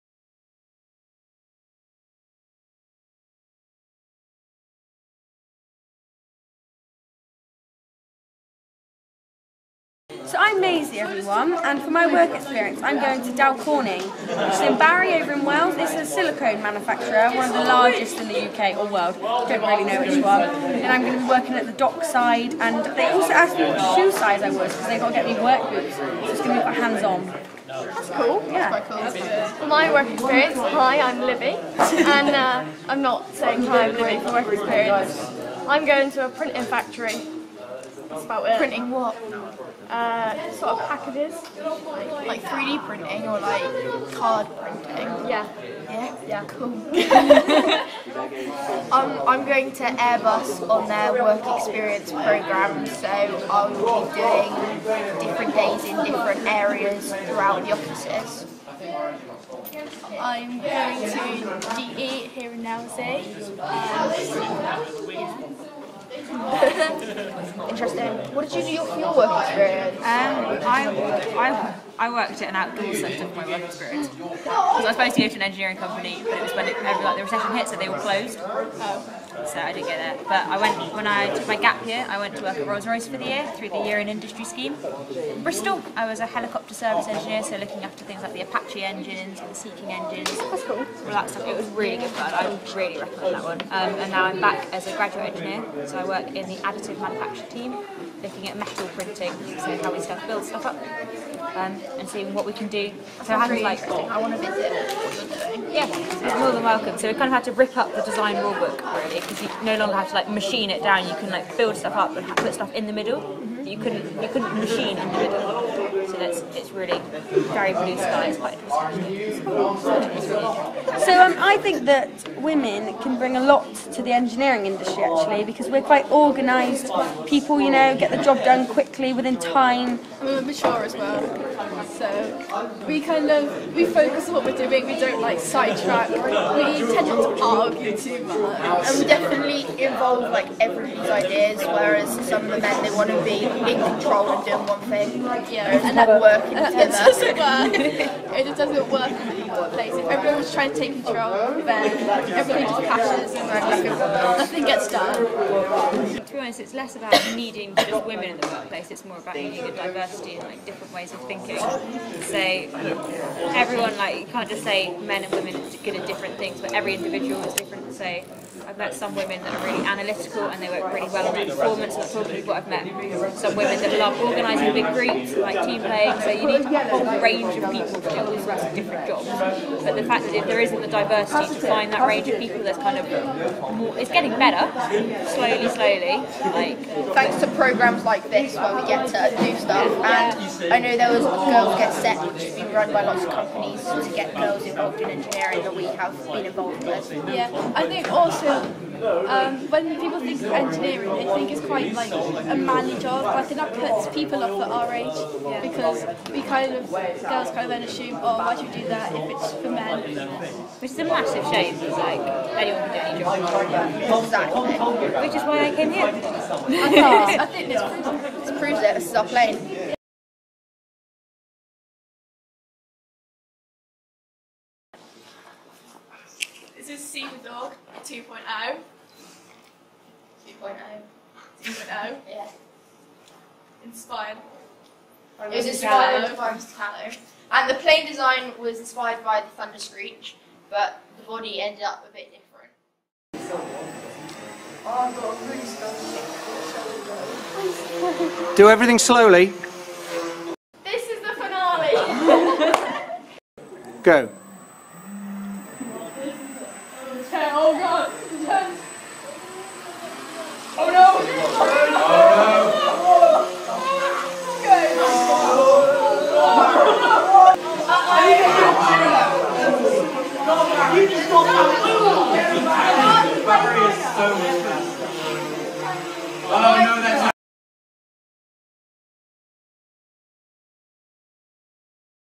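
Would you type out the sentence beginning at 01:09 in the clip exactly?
Um, I, I, I worked at an outdoor centre for my work experience.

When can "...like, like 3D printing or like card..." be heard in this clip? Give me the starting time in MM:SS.
00:41.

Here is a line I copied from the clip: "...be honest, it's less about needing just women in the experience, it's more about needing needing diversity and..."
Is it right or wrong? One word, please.
wrong.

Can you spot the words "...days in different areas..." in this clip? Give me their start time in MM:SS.
00:55.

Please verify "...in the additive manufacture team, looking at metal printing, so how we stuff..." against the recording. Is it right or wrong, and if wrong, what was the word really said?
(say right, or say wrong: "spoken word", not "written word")
right.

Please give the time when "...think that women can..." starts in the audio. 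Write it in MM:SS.
02:01.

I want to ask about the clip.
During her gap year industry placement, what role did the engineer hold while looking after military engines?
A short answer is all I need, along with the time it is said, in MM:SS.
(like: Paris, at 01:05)
Helicopter service engineer, at 01:26.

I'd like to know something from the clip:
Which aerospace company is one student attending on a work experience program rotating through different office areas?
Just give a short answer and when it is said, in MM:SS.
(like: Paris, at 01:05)
Airbus, at 00:49.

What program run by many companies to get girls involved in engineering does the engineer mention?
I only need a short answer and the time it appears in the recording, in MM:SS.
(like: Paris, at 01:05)
Girls Get Set, at 03:11.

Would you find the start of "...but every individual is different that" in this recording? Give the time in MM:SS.
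02:46.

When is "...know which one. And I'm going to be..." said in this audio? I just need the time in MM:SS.
00:19.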